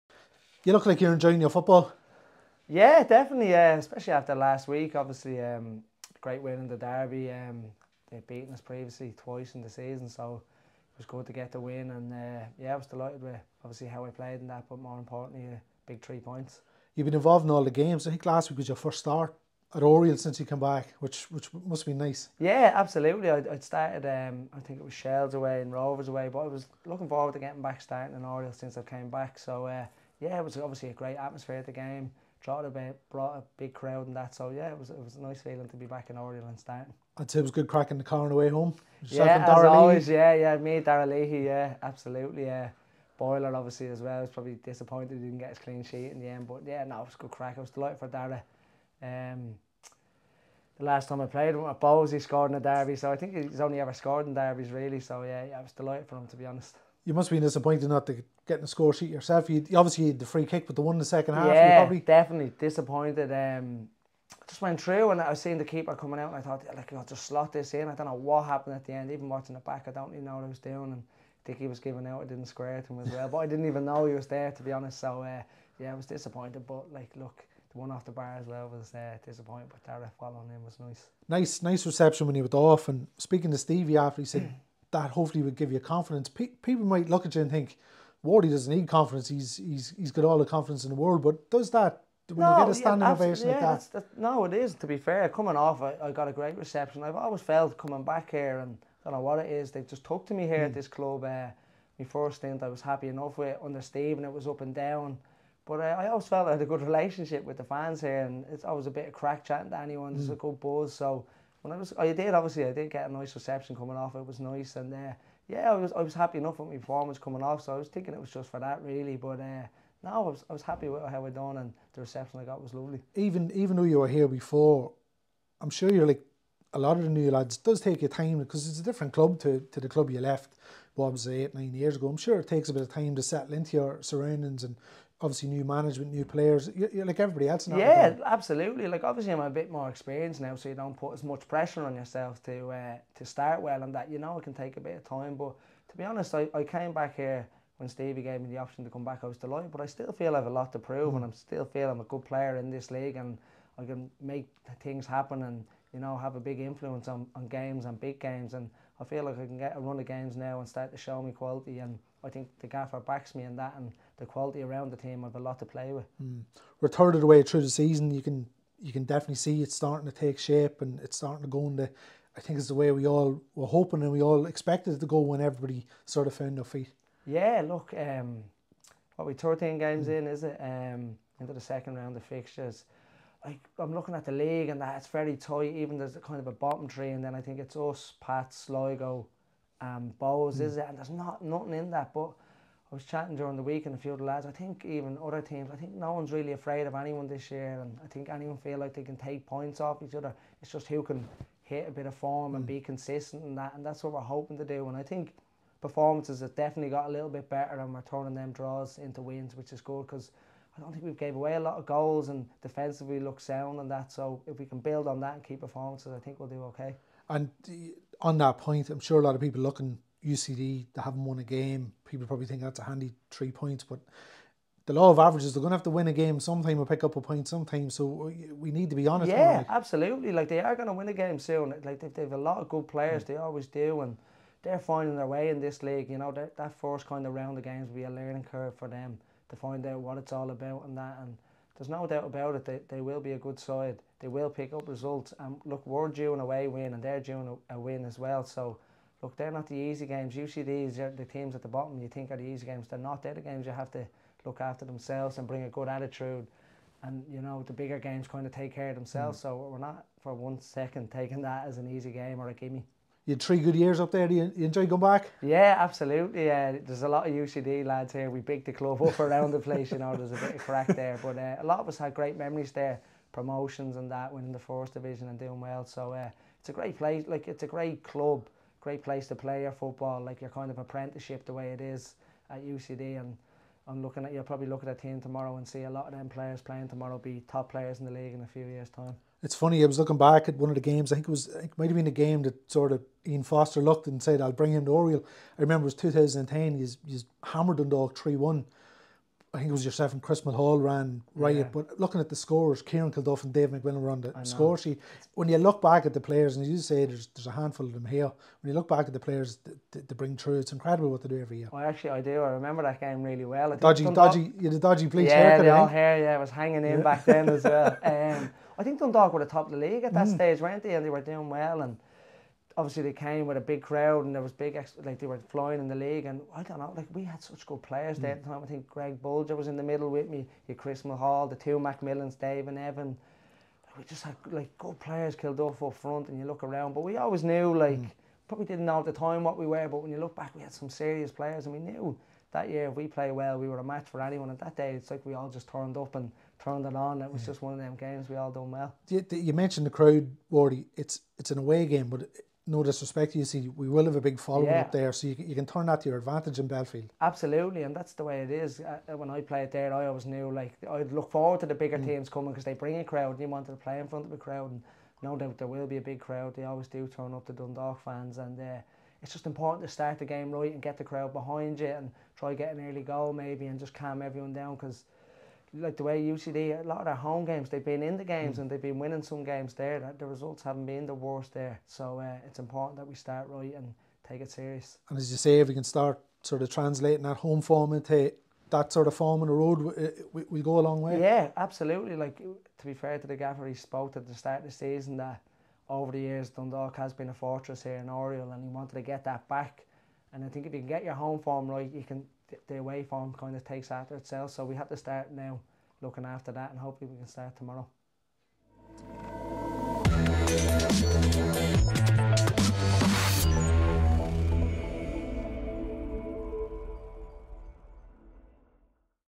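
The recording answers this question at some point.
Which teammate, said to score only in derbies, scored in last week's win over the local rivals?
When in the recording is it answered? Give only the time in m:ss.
0:48.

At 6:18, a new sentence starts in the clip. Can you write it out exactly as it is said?
and they've been winning some games there.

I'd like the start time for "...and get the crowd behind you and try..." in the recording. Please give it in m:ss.
6:10.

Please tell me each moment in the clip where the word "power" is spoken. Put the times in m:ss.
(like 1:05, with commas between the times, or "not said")
not said.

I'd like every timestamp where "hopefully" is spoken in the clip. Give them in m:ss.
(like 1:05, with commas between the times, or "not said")
1:25, 6:46.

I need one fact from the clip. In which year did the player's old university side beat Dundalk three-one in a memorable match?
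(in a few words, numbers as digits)
2010.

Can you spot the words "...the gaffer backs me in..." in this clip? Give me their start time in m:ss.
2:42.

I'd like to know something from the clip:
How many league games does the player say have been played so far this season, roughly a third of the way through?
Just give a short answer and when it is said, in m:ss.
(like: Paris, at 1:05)
13, at 2:59.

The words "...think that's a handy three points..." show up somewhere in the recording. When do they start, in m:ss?
3:42.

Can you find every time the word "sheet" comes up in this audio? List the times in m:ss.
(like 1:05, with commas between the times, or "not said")
0:45, 0:58, 5:04.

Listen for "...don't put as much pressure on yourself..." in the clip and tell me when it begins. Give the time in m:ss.
2:20.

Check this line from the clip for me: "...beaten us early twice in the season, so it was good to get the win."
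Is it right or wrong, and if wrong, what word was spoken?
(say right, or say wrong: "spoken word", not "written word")
wrong: "previously", not "early".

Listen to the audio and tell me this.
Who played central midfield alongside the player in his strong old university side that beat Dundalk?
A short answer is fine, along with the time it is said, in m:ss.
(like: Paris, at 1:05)
Greg Bulger, at 5:28.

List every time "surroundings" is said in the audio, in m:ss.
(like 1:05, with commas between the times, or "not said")
2:14.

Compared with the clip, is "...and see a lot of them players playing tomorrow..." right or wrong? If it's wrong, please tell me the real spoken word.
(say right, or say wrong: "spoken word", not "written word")
right.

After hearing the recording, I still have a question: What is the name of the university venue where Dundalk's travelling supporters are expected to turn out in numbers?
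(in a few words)
Belfield.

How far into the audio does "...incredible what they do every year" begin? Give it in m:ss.
5:10.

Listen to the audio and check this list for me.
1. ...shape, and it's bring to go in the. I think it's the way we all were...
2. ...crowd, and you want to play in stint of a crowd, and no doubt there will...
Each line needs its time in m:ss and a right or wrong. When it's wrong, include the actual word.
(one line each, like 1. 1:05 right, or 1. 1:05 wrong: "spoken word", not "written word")
1. 2:50 wrong: "starting", not "bring"
2. 6:03 wrong: "front", not "stint".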